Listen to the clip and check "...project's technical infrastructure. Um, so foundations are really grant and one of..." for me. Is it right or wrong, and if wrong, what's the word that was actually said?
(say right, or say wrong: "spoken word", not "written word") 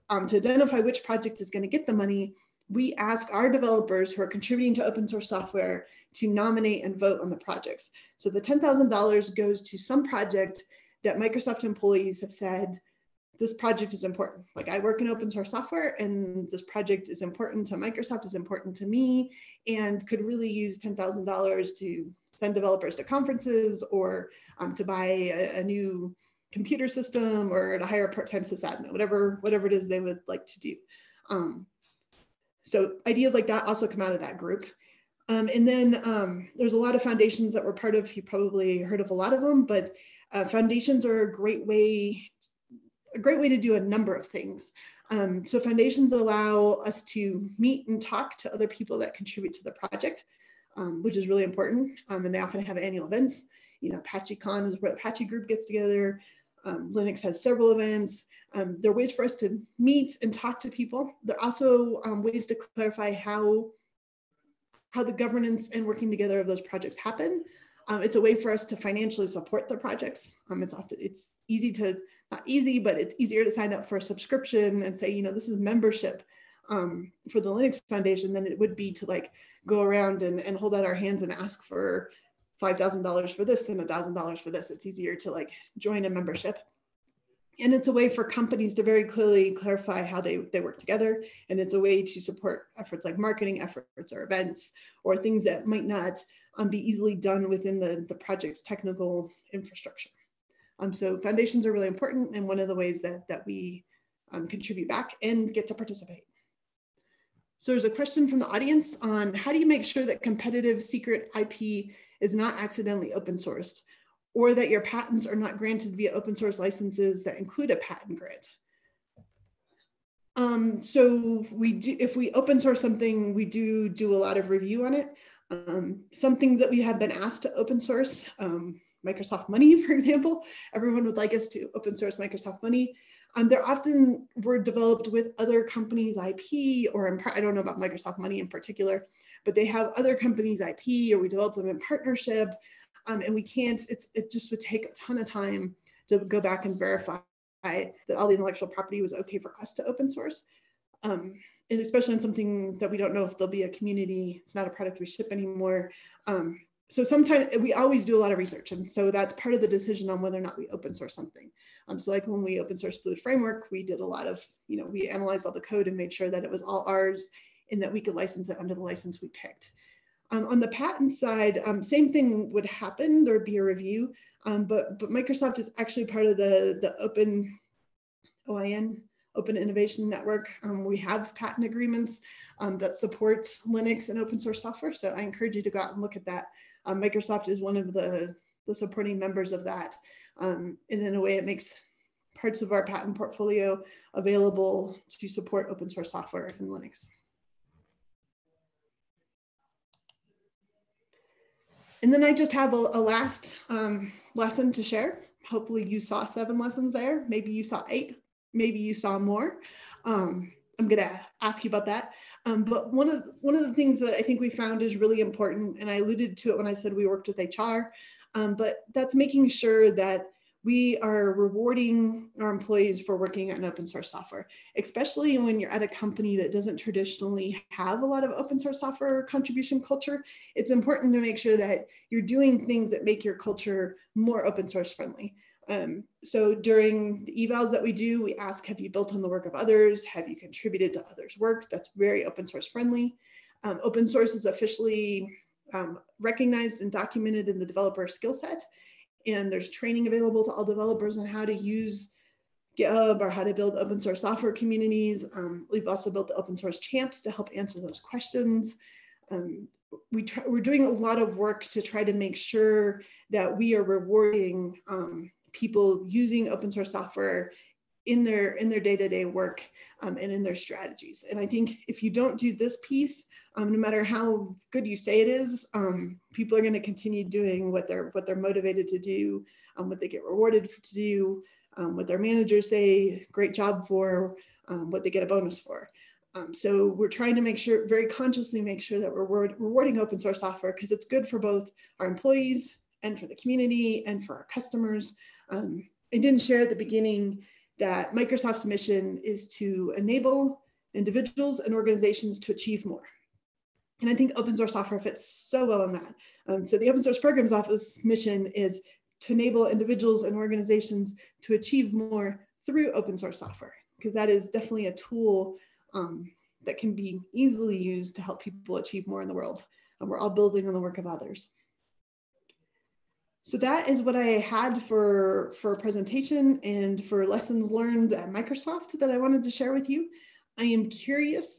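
wrong: "important", not "grant".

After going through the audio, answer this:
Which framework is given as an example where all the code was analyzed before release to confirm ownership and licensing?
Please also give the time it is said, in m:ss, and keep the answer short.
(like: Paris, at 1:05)
Fluid Framework, at 2:42.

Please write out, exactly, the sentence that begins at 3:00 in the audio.
Um, we have patent agreements um, that support Linux and open source software.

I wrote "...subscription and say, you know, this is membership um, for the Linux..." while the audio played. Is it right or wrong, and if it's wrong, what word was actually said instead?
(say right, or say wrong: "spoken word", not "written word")
right.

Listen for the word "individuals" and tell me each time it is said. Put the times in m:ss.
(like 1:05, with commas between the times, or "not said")
5:00, 5:09.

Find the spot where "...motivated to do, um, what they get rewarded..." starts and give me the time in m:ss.
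4:38.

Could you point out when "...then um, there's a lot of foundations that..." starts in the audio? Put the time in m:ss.
0:35.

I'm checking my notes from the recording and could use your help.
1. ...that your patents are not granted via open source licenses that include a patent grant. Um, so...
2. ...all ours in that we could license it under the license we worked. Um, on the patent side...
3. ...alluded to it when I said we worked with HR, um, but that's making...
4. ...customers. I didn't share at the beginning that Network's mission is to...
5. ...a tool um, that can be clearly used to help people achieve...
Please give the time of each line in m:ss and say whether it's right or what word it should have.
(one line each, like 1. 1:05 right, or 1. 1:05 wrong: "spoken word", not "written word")
1. 1:54 right
2. 2:46 wrong: "picked", not "worked"
3. 3:35 right
4. 4:54 wrong: "Microsoft", not "Network"
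5. 5:14 wrong: "easily", not "clearly".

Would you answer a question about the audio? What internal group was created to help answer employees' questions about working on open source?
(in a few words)
open source champs.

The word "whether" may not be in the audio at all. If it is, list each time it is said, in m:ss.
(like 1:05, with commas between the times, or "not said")
2:40.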